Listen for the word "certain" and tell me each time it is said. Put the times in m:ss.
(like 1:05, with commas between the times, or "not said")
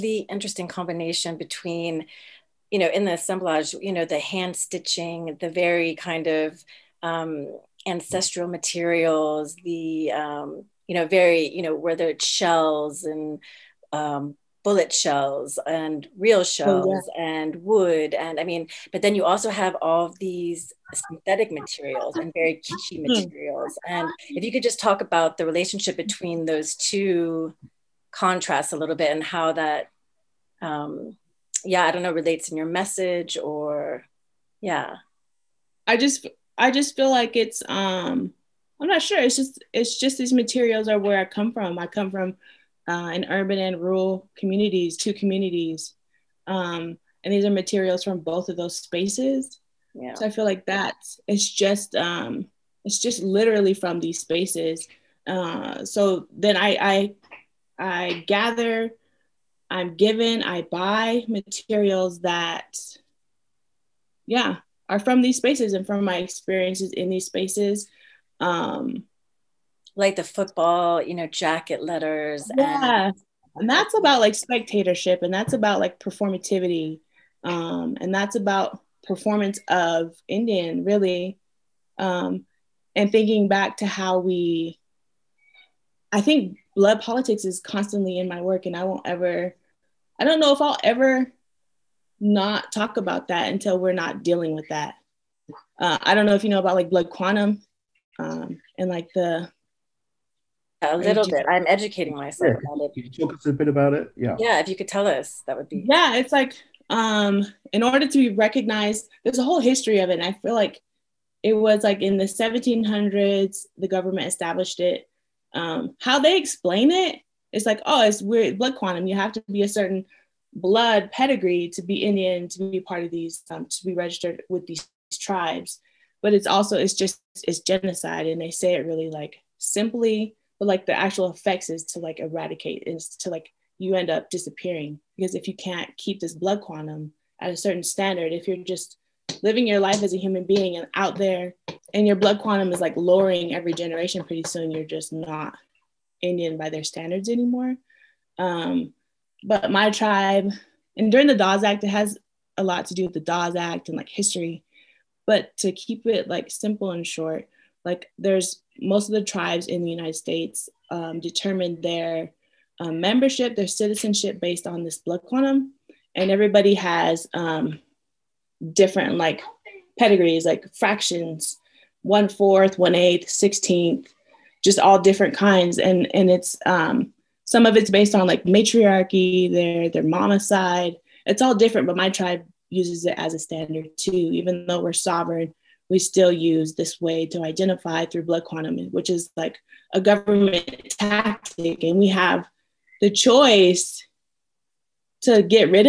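1:59, 2:17.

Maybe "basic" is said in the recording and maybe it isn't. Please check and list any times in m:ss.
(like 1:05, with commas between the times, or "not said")
not said.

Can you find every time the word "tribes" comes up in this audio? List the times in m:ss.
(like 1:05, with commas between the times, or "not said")
2:05, 2:29, 2:39, 3:02.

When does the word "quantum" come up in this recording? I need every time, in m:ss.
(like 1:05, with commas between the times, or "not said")
1:37, 1:58, 2:16, 2:22, 2:45, 3:08.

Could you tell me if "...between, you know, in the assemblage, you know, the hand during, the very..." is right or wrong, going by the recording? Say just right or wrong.
wrong.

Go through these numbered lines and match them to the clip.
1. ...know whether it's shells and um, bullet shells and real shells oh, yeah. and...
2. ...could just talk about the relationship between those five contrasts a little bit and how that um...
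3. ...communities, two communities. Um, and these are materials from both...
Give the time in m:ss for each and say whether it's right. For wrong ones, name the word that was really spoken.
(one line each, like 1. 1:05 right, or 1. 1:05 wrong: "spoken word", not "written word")
1. 0:11 right
2. 0:24 wrong: "two", not "five"
3. 0:44 right.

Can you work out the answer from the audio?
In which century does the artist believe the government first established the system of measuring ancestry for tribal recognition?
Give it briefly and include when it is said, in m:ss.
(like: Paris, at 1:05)
1700s, at 1:52.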